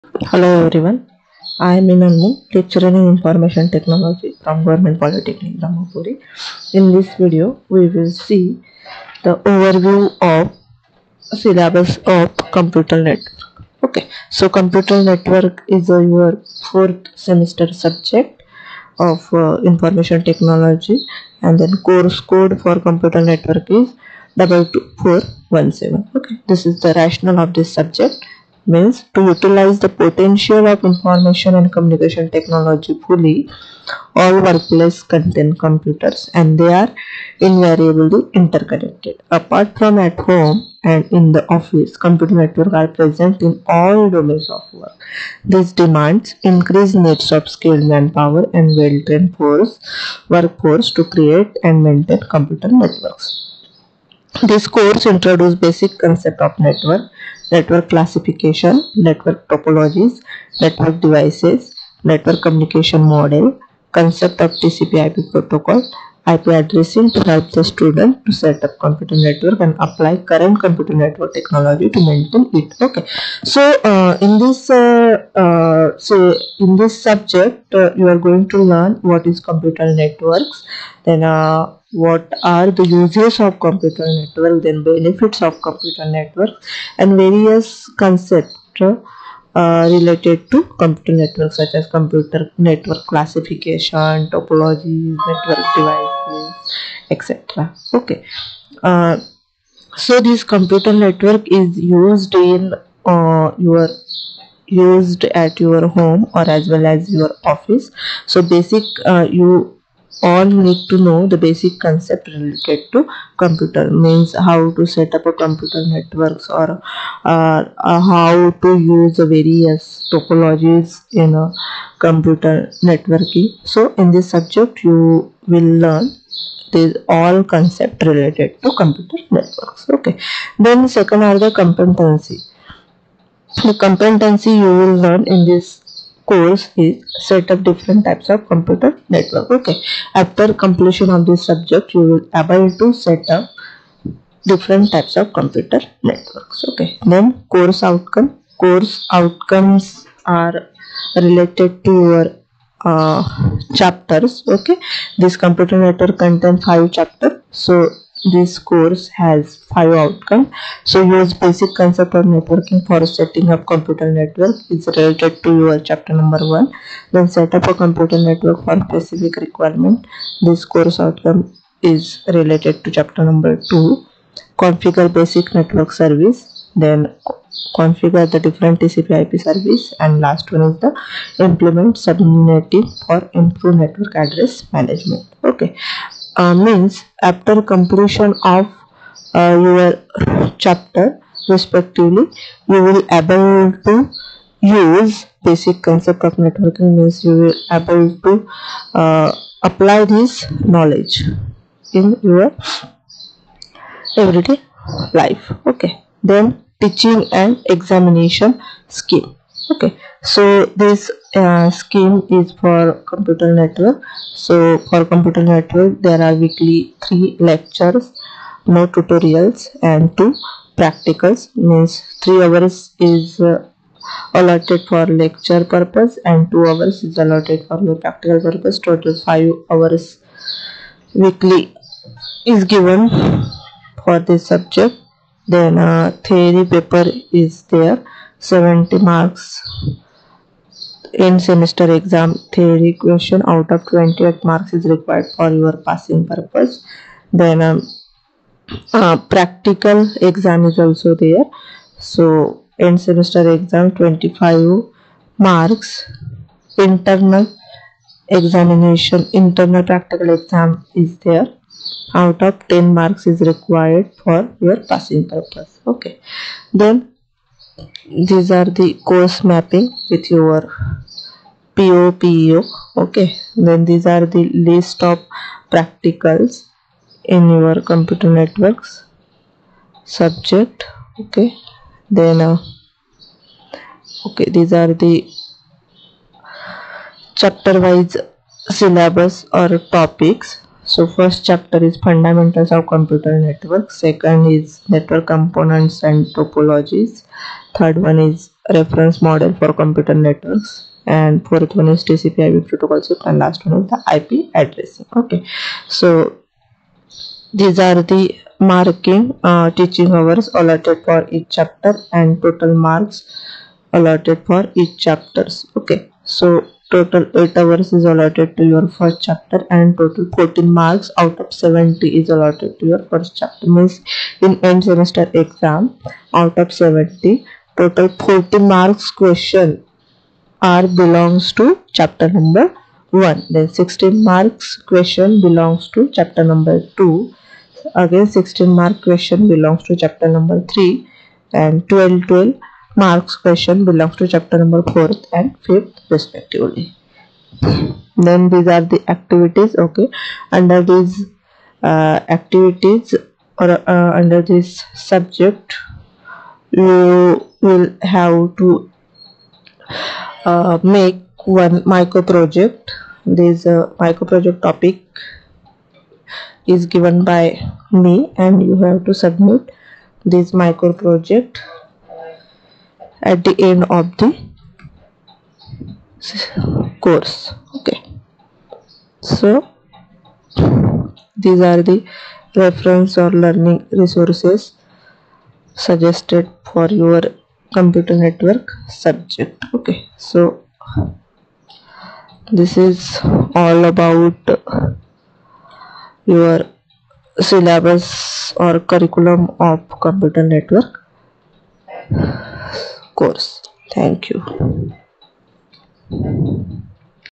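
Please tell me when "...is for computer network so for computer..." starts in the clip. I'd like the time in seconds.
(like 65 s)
212 s.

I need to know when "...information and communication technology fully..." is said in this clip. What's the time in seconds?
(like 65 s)
30 s.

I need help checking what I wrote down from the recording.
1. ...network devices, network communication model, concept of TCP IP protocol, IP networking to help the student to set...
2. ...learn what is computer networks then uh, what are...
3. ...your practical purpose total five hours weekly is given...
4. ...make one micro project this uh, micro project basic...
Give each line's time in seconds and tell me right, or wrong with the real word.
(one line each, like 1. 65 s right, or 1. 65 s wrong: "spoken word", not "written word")
1. 60 s wrong: "addressing", not "networking"
2. 78 s right
3. 227 s right
4. 360 s wrong: "topic", not "basic".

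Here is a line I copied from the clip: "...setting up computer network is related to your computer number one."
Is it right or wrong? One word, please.
wrong.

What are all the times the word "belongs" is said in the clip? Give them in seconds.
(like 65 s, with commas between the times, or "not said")
330 s, 335 s, 339 s, 343 s.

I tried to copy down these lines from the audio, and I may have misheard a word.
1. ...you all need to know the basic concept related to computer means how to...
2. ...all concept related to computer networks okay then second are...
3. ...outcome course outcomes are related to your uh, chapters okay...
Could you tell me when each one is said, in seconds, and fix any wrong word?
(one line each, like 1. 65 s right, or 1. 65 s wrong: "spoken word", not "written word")
1. 109 s right
2. 127 s right
3. 147 s right.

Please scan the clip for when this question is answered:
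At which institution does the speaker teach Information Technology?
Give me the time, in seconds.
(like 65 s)
4 s.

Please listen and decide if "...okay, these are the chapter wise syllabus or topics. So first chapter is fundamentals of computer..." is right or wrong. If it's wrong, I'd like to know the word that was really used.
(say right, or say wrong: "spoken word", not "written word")
right.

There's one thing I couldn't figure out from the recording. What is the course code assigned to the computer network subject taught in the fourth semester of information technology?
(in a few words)
22417.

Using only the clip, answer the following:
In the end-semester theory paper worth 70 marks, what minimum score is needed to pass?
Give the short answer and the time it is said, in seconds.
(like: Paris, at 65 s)
28, at 243 s.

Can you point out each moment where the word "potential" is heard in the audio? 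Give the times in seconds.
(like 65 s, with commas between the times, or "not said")
29 s.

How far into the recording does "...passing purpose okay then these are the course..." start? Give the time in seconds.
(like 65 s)
264 s.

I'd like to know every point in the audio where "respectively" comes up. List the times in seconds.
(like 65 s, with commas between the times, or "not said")
191 s, 346 s.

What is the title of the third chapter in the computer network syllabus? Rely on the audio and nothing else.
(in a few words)
Reference model for computer networks.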